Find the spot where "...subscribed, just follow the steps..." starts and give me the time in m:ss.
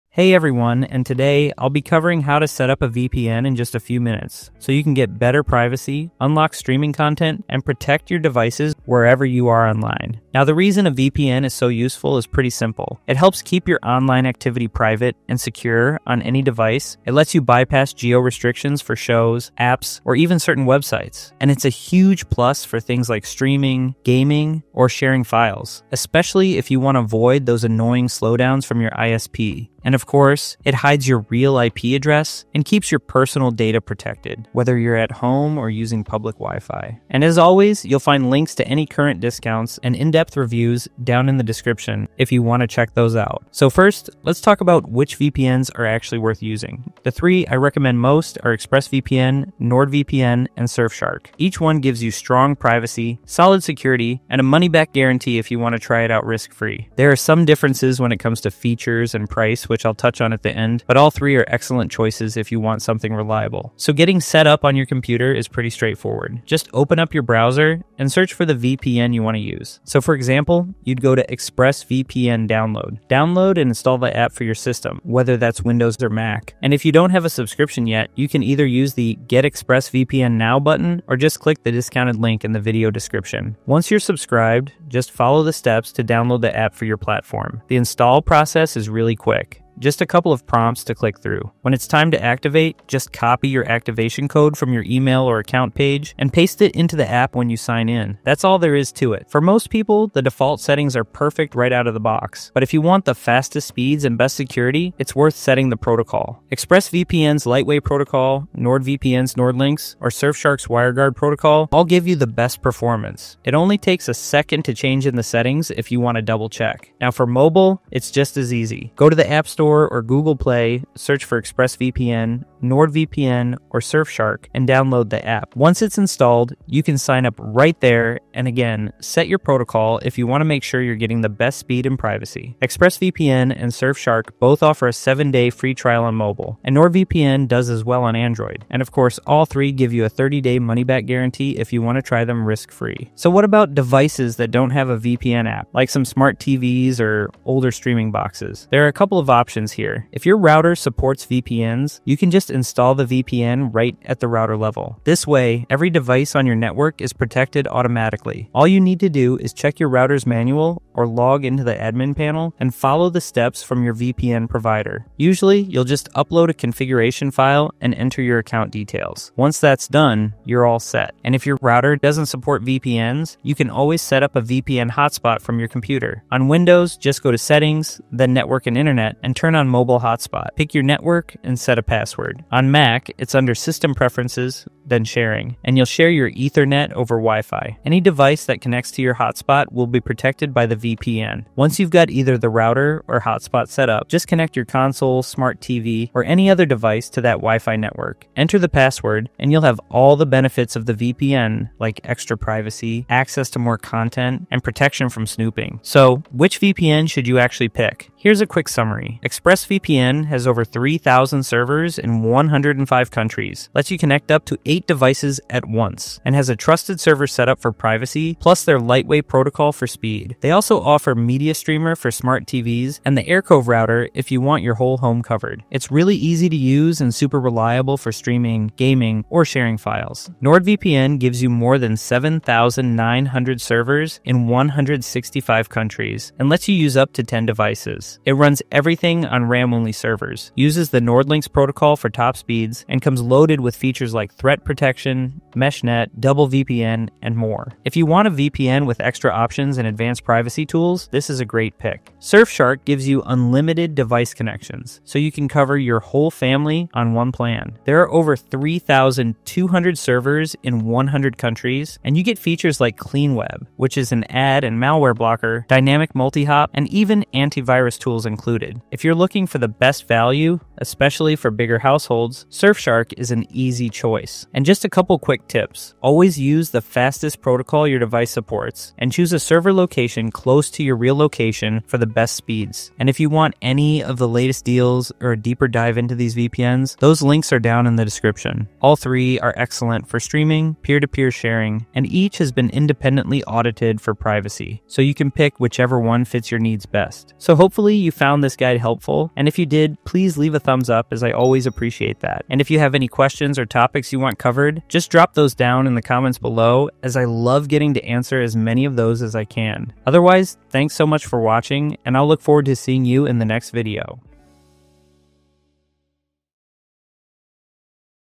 1:24.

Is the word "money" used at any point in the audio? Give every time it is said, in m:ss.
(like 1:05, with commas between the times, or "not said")
0:54, 2:20.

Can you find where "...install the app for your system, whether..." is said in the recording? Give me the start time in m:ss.
1:13.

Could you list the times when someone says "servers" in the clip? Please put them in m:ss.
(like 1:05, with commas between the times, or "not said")
3:31, 3:36, 3:53, 3:59, 4:19, 4:39.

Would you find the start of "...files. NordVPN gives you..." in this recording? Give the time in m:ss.
3:49.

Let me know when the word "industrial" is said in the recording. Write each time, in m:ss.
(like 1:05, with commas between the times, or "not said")
not said.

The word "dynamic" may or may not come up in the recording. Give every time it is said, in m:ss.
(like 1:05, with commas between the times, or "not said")
4:25.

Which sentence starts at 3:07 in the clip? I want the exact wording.
Any device that connects to your hotspot will be protected by the VPN.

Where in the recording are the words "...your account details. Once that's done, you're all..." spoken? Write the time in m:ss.
2:48.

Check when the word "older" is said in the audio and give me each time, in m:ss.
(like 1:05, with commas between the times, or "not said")
2:27.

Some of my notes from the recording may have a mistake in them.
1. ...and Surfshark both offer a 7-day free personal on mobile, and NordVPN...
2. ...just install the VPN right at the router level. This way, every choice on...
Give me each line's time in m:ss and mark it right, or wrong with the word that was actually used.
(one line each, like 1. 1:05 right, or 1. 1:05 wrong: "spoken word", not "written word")
1. 2:13 wrong: "trial", not "personal"
2. 2:32 wrong: "device", not "choice".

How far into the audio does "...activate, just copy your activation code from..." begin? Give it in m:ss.
1:32.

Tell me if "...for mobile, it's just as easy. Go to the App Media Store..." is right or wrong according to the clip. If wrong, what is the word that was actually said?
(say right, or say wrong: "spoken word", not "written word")
wrong: "Store", not "Media".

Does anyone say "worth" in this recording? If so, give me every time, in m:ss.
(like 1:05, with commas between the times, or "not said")
0:46, 1:45.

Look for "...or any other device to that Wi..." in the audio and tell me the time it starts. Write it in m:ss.
3:16.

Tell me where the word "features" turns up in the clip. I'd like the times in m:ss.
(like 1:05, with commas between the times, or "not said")
0:58, 4:03, 4:22.